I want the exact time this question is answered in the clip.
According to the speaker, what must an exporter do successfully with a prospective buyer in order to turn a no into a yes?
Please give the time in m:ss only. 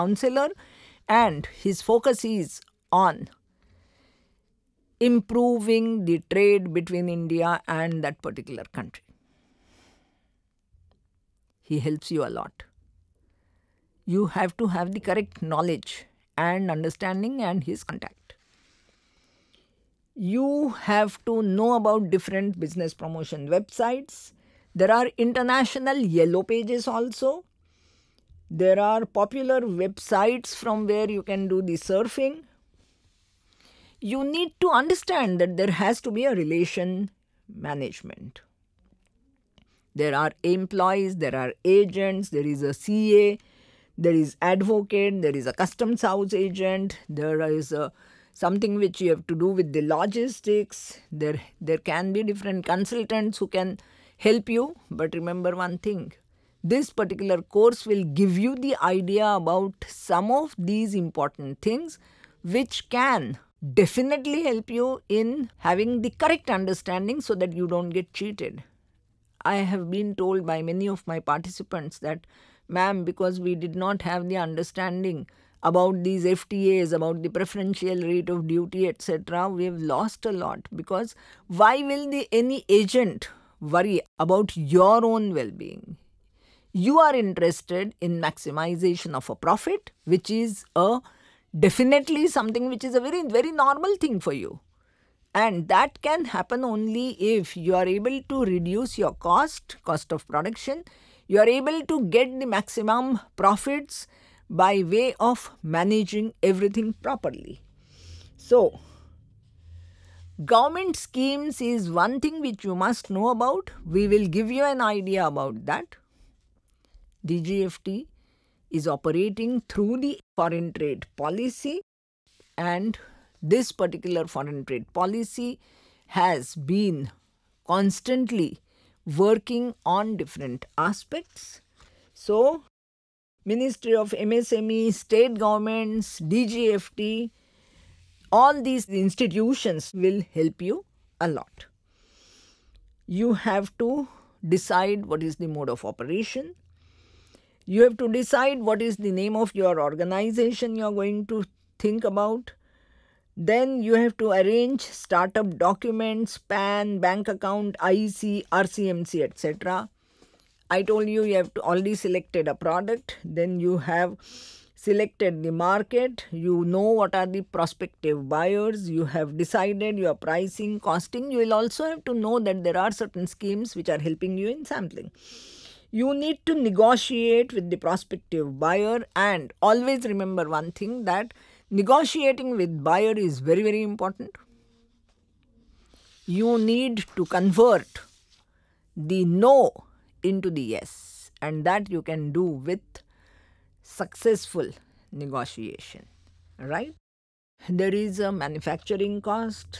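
3:13.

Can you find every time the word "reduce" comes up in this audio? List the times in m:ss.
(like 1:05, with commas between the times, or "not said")
1:38.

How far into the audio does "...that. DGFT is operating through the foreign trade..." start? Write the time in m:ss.
1:55.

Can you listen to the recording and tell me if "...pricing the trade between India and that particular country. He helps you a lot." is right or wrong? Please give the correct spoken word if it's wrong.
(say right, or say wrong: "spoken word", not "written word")
wrong: "improving", not "pricing".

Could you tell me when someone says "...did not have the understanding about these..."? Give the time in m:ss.
1:13.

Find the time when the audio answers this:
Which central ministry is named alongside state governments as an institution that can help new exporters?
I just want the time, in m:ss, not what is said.
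2:13.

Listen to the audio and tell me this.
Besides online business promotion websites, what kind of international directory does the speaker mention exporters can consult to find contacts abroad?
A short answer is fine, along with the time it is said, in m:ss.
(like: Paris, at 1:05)
International yellow pages, at 0:25.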